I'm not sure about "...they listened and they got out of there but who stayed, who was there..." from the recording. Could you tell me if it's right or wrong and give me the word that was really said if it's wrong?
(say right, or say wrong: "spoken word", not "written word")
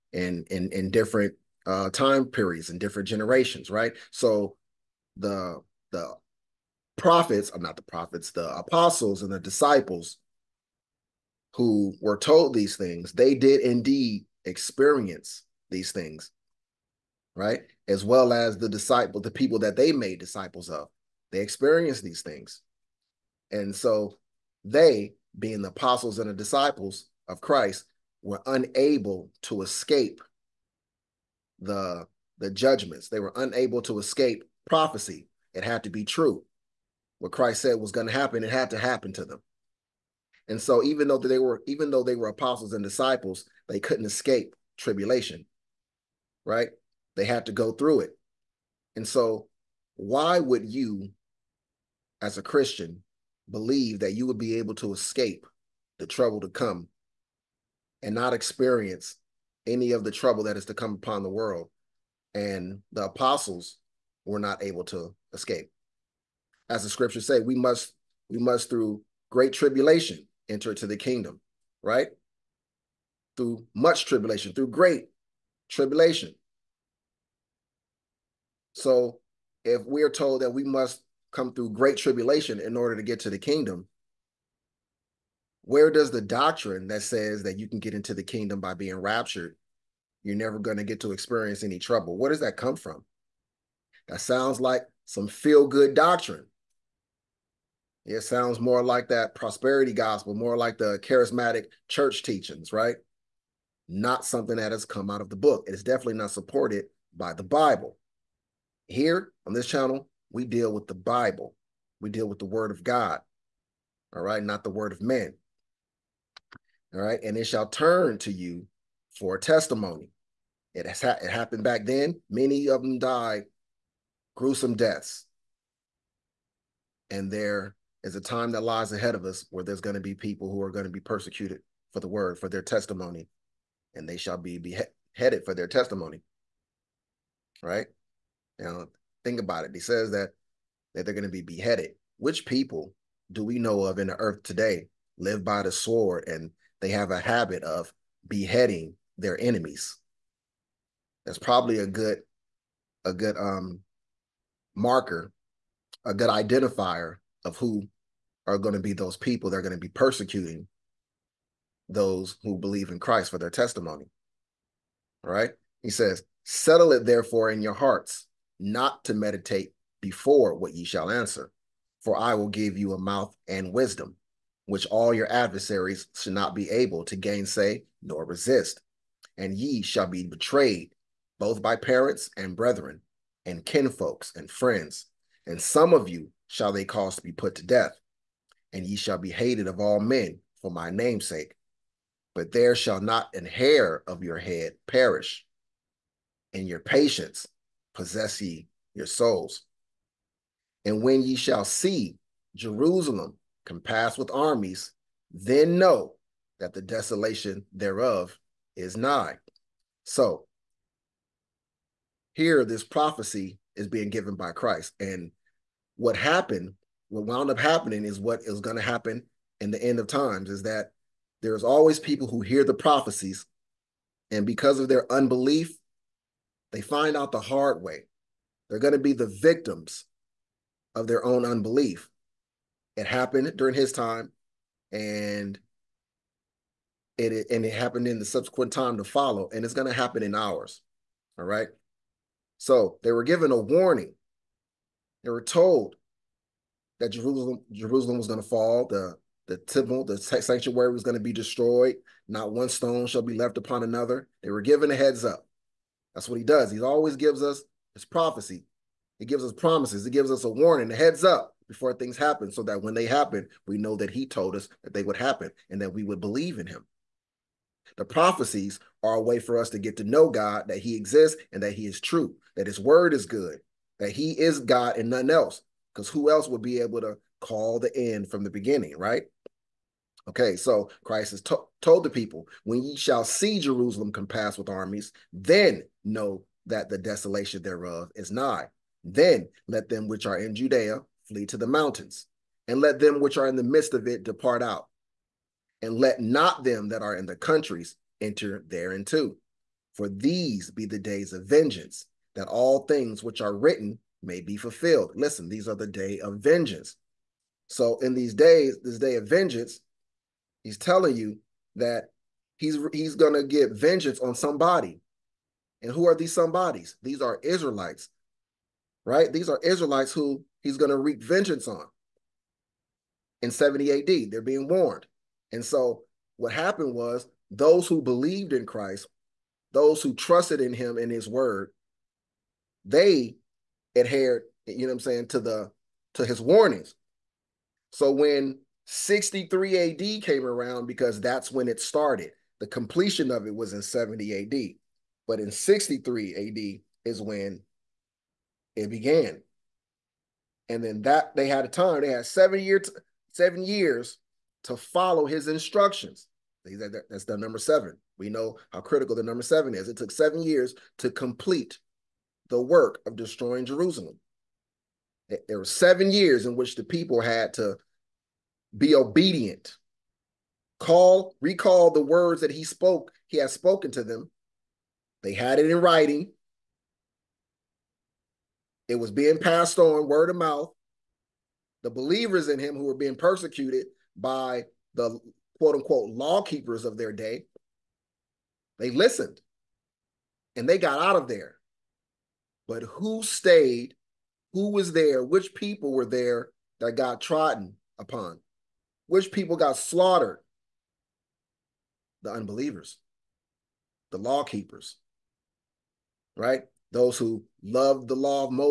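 right.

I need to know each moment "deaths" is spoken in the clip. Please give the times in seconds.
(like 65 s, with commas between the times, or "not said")
124 s, 187 s.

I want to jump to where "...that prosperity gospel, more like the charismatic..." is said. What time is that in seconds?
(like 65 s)
99 s.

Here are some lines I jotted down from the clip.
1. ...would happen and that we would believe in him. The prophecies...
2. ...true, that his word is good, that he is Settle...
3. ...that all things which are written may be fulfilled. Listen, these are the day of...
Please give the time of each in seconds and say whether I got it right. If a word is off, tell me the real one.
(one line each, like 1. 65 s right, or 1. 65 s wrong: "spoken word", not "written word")
1. 265 s right
2. 272 s wrong: "God", not "Settle"
3. 302 s right.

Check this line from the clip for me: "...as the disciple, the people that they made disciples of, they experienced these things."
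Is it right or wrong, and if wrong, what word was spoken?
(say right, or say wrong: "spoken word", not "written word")
right.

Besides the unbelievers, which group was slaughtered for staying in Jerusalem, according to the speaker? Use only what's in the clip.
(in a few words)
the law keepers.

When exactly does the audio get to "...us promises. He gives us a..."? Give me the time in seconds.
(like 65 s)
259 s.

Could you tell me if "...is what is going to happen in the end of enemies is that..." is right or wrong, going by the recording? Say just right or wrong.
wrong.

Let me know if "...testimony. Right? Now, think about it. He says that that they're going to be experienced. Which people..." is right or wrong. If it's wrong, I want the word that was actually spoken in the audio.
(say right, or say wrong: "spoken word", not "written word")
wrong: "beheaded", not "experienced".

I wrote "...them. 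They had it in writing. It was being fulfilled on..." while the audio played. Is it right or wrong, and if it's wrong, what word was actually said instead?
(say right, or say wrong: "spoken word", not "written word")
wrong: "passed", not "fulfilled".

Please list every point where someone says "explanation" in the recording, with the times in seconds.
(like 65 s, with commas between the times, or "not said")
not said.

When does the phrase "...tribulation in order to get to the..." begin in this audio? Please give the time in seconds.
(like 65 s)
81 s.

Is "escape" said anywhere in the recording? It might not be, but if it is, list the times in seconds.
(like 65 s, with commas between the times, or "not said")
29 s, 33 s, 44 s, 54 s, 65 s.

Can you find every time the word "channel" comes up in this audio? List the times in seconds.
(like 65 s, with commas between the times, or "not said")
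109 s.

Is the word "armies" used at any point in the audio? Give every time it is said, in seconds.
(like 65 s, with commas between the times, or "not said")
204 s, 284 s.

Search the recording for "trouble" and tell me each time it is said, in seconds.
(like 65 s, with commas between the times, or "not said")
56 s, 60 s, 91 s.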